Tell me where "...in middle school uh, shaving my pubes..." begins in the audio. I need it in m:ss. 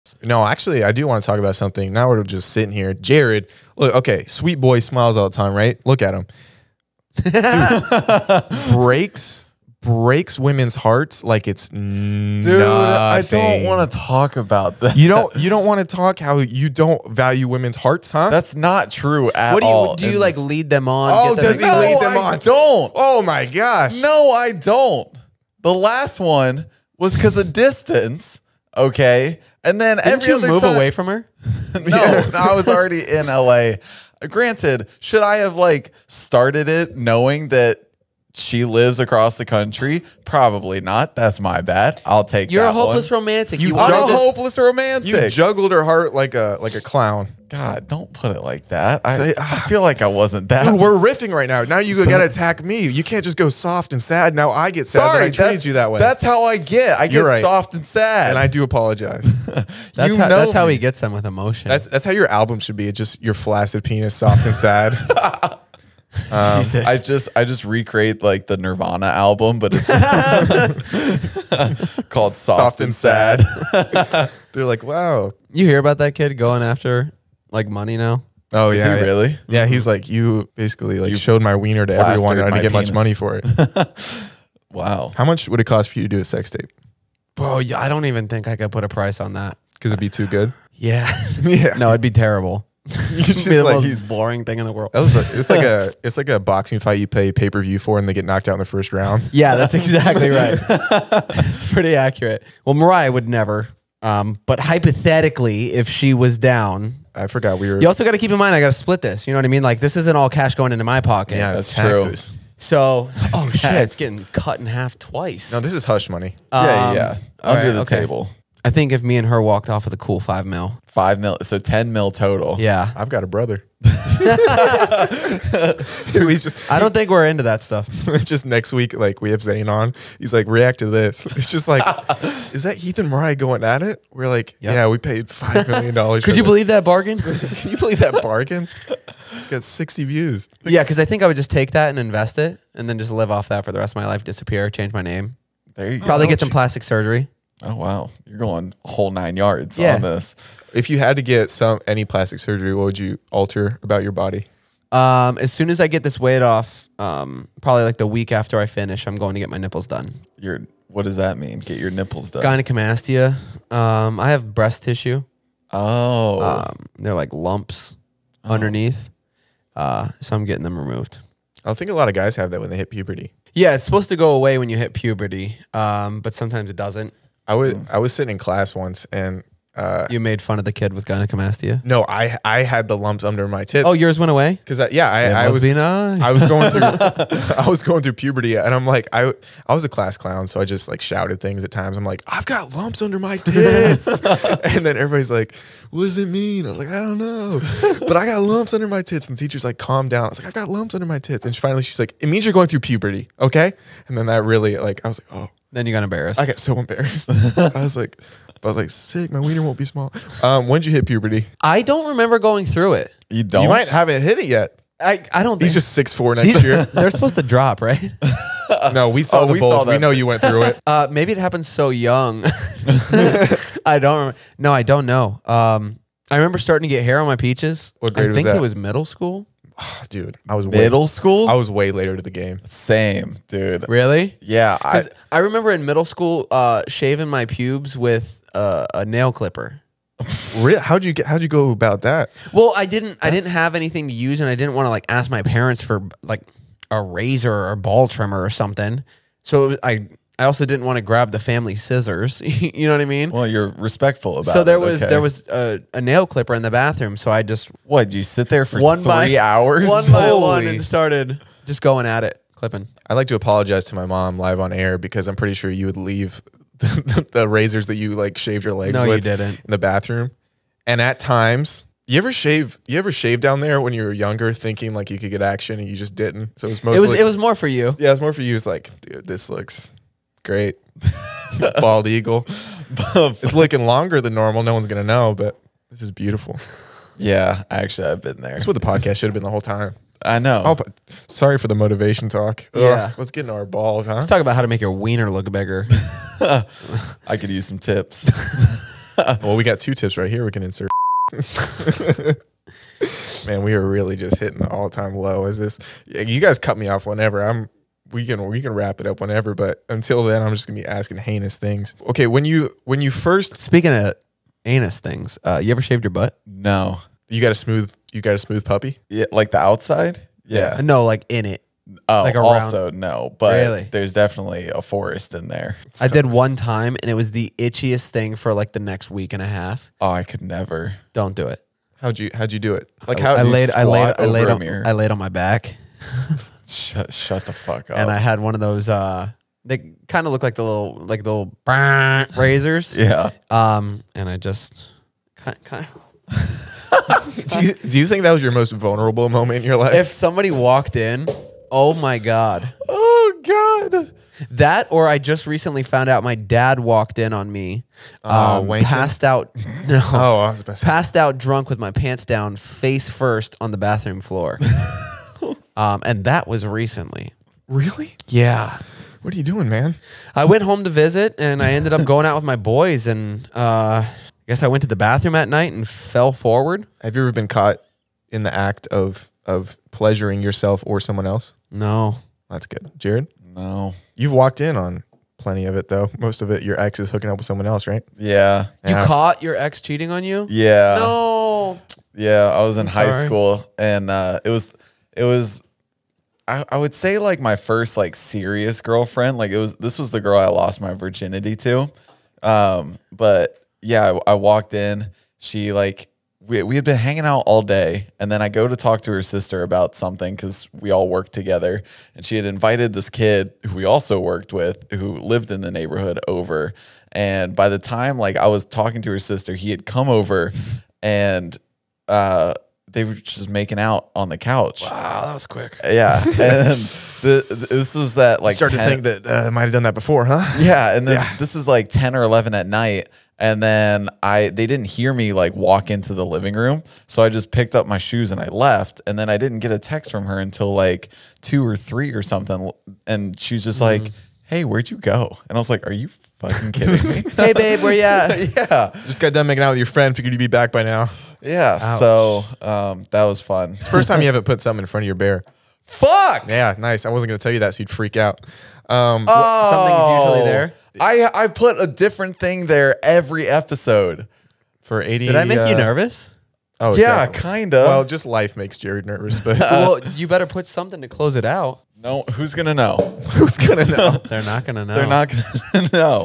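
3:55.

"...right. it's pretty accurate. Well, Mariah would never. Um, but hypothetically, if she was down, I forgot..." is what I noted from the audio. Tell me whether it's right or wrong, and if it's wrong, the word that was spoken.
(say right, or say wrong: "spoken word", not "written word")
right.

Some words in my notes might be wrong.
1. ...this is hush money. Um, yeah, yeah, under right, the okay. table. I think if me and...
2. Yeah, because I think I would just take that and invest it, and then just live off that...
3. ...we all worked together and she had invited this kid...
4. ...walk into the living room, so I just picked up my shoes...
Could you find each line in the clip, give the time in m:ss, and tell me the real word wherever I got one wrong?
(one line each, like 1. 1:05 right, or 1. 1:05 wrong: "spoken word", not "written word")
1. 1:55 right
2. 2:20 right
3. 6:50 right
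4. 7:15 right.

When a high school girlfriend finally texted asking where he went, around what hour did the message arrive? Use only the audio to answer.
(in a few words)
2 or 3.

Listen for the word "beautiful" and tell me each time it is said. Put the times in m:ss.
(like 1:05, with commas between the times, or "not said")
4:46.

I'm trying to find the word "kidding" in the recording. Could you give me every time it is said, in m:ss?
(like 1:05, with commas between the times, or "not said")
7:26.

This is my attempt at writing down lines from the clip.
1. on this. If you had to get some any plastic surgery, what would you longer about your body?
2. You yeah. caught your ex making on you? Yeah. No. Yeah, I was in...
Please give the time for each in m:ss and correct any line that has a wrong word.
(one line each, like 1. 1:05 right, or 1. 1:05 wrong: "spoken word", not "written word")
1. 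2:29 wrong: "alter", not "longer"
2. 6:28 wrong: "cheating", not "making".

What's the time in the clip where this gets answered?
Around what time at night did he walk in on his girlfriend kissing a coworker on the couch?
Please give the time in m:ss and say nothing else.
7:11.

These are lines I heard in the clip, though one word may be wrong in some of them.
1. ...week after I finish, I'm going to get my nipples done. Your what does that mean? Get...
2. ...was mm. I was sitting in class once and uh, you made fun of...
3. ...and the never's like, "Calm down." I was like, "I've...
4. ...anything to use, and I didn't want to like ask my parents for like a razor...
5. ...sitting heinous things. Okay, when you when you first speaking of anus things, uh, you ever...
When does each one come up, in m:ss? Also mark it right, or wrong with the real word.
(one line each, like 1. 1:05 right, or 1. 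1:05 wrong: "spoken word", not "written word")
1. 2:38 right
2. 2:57 right
3. 3:19 wrong: "teacher", not "never"
4. 4:03 right
5. 5:10 wrong: "asking", not "sitting".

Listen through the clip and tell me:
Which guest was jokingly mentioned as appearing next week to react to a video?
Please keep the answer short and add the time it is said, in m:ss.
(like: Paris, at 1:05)
Zane, at 2:09.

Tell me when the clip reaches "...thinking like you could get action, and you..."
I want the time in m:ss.
4:34.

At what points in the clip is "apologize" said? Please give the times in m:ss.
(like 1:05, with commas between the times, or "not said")
0:58, 4:23.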